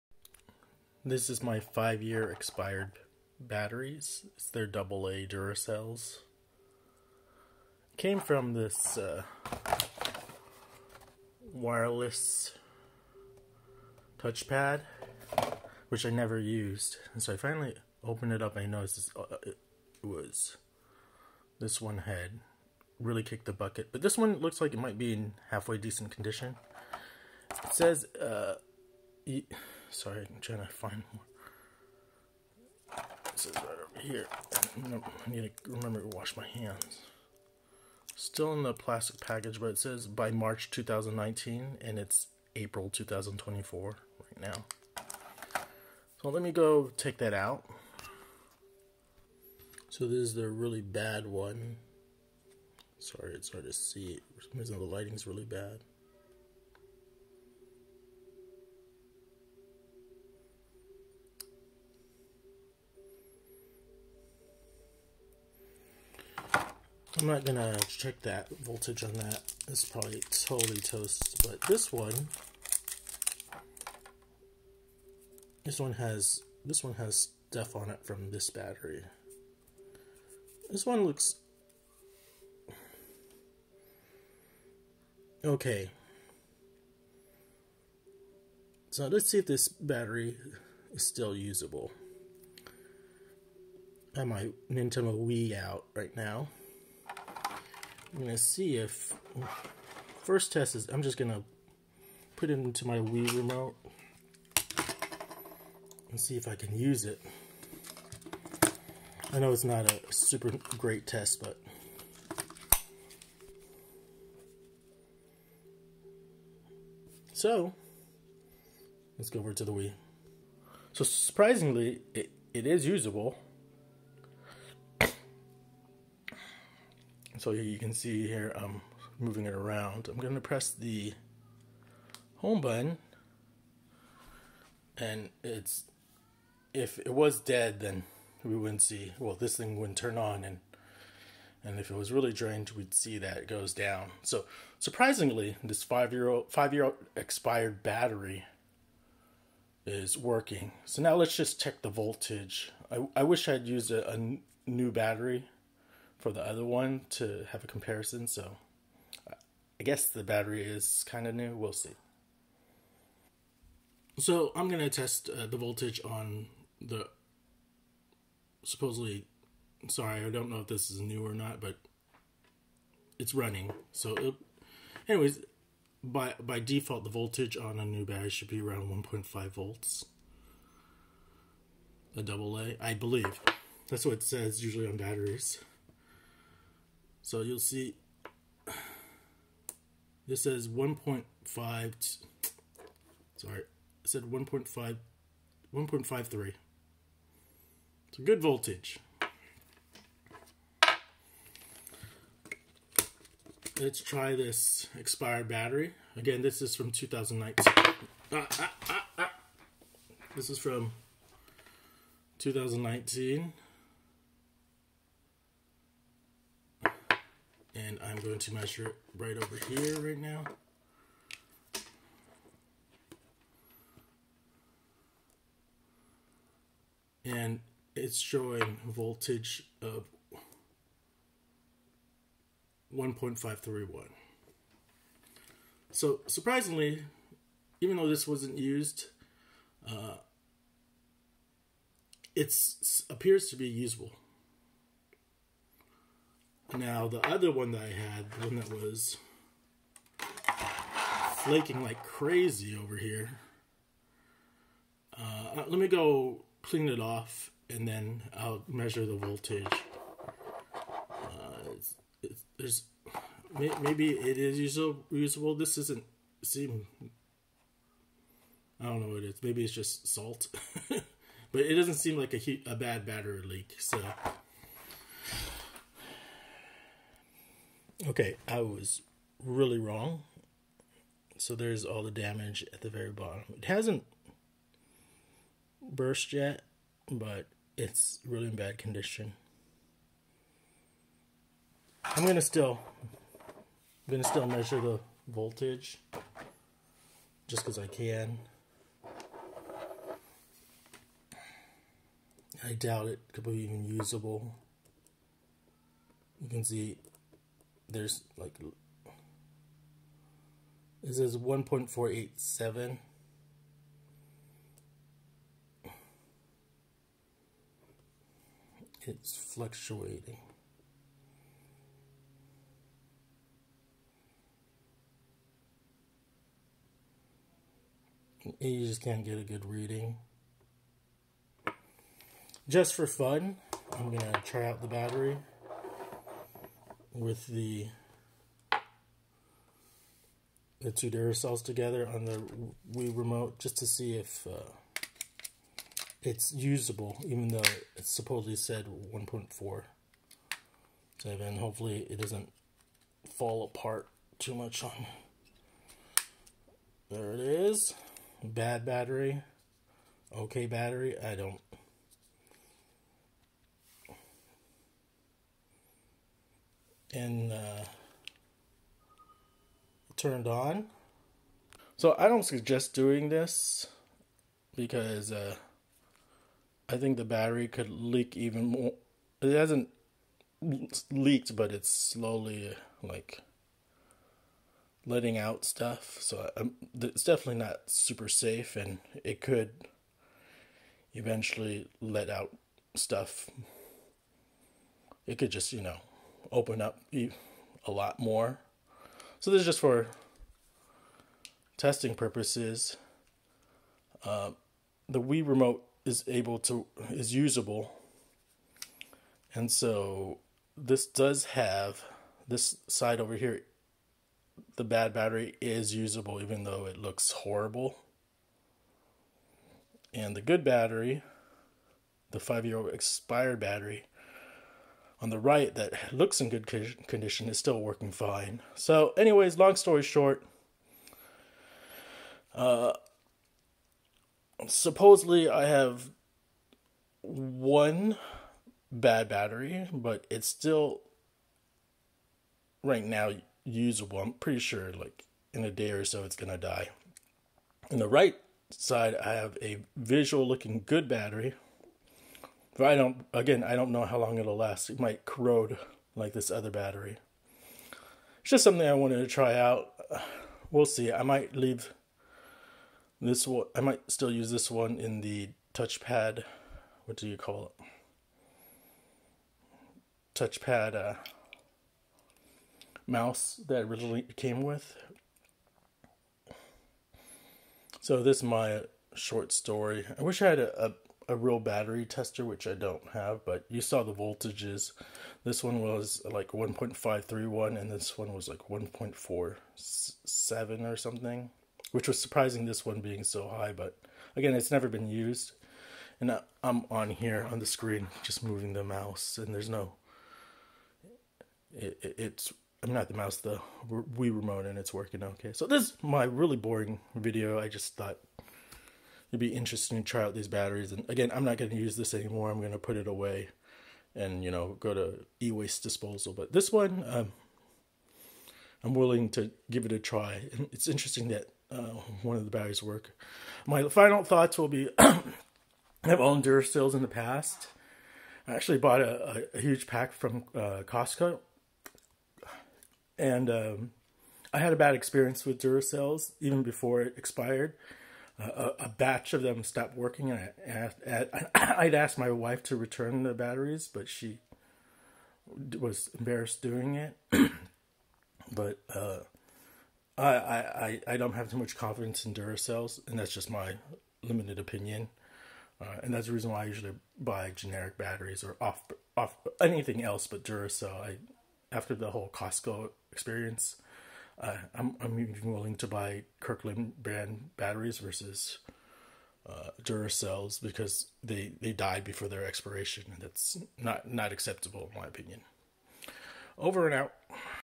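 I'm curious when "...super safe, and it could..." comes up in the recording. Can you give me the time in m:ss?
6:27.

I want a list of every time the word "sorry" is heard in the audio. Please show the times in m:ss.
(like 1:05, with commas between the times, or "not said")
0:29, 0:52, 2:49, 3:13.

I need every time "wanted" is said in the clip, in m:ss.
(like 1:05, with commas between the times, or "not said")
7:38.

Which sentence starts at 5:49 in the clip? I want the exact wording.
So then hopefully it doesn't fall apart too much on.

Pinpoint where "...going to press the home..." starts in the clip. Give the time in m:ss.
2:10.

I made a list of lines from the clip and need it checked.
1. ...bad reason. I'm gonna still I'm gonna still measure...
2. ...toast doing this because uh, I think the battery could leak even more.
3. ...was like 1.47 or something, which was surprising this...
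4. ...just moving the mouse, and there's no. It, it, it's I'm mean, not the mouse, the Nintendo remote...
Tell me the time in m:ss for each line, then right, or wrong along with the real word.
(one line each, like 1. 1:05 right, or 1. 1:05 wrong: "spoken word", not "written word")
1. 4:48 wrong: "condition", not "reason"
2. 6:12 wrong: "suggest", not "toast"
3. 8:08 right
4. 8:18 wrong: "Wii", not "Nintendo".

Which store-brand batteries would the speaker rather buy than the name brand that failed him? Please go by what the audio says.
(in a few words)
Kirkland.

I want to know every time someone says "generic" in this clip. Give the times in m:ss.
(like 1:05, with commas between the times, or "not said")
9:17.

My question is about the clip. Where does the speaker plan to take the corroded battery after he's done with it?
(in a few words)
e-waste disposal.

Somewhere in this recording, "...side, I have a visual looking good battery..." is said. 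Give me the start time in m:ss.
7:28.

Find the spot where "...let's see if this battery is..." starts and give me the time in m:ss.
1:29.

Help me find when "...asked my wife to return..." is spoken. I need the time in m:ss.
9:01.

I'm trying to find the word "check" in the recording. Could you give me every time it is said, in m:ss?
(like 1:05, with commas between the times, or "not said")
1:07, 2:31.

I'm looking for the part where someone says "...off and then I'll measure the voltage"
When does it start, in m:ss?
4:17.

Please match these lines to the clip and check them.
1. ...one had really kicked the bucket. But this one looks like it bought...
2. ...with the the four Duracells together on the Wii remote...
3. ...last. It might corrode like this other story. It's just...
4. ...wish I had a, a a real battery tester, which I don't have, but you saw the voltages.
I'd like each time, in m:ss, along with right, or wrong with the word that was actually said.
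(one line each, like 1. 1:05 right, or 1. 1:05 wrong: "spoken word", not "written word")
1. 0:21 wrong: "might", not "bought"
2. 5:37 wrong: "two", not "four"
3. 7:34 wrong: "battery", not "story"
4. 8:00 right.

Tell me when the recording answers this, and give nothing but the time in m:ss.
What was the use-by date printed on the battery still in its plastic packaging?
0:40.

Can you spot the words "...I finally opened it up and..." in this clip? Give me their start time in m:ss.
0:17.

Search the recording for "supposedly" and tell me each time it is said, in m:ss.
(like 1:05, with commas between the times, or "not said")
2:48, 5:48, 7:14.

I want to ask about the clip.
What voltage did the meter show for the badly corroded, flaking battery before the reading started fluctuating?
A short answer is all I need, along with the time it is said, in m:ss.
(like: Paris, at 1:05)
1.487, at 5:11.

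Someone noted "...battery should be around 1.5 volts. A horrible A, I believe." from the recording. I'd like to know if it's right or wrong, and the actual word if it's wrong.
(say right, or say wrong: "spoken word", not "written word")
wrong: "double", not "horrible".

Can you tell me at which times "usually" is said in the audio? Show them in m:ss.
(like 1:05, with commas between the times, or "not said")
3:04, 9:16.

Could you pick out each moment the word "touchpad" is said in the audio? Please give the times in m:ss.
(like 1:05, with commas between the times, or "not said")
0:14, 7:45, 7:50.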